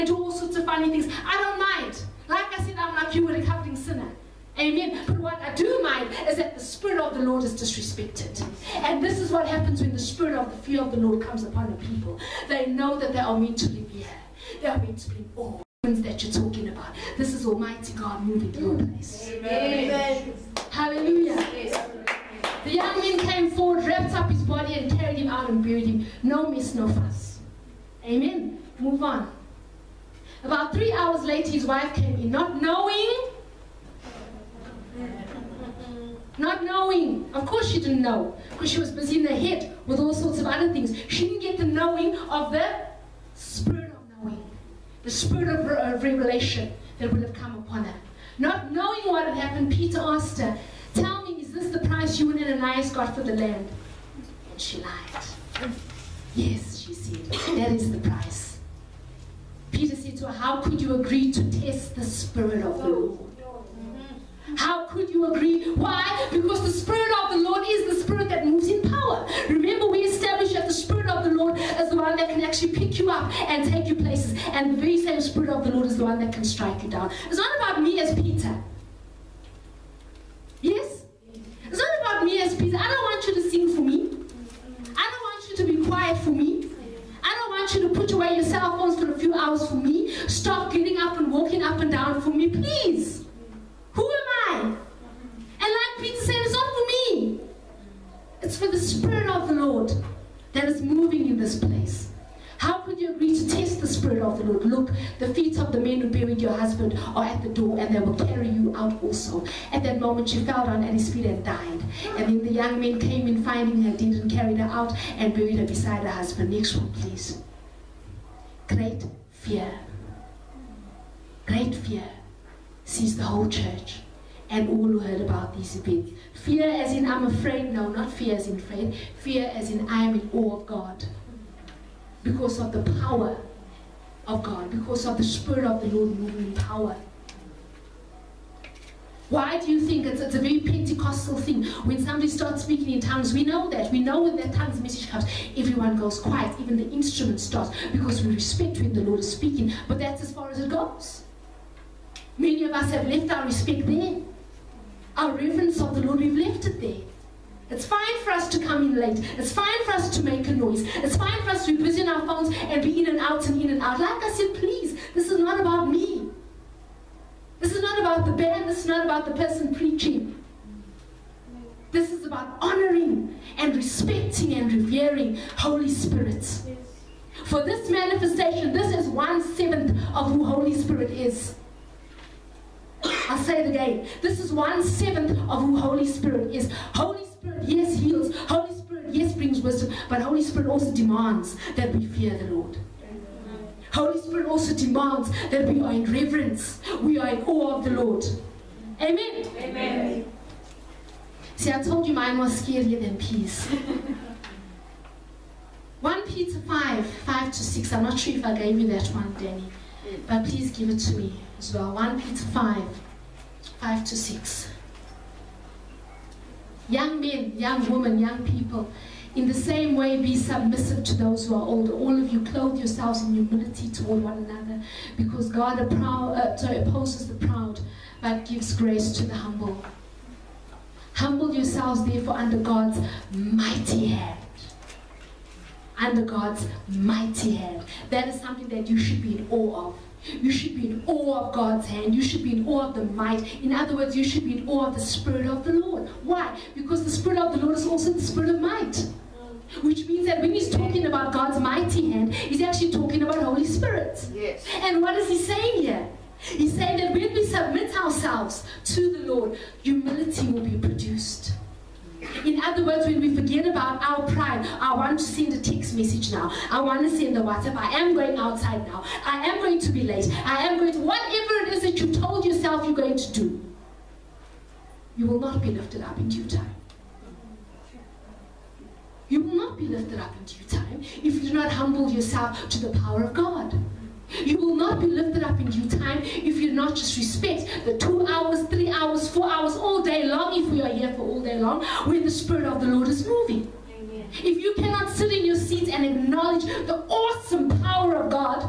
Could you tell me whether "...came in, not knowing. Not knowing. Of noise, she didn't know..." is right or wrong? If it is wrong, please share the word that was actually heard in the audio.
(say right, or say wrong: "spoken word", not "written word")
wrong: "course", not "noise".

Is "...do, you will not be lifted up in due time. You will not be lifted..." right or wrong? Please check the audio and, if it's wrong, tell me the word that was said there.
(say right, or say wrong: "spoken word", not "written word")
right.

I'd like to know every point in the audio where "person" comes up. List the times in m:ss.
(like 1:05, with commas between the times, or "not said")
2:49.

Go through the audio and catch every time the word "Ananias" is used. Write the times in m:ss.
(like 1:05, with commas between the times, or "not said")
0:52.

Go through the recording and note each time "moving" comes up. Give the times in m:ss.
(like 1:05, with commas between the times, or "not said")
0:18, 1:40, 2:16, 4:53.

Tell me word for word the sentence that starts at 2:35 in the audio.
Our reverence of the Lord, we've left it there.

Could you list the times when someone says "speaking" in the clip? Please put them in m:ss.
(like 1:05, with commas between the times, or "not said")
2:22, 2:29.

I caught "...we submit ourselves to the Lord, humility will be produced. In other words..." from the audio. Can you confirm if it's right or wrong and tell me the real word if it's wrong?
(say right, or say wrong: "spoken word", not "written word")
right.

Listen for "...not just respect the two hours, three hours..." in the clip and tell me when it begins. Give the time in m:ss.
4:46.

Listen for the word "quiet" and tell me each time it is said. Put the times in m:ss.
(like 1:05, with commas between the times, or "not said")
1:25, 2:26.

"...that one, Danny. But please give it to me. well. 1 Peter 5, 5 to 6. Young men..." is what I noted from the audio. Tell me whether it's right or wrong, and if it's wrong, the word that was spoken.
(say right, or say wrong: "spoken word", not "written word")
right.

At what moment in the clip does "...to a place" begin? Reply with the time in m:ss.
0:18.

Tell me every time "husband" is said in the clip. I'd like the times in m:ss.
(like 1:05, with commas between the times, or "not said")
1:46, 1:56.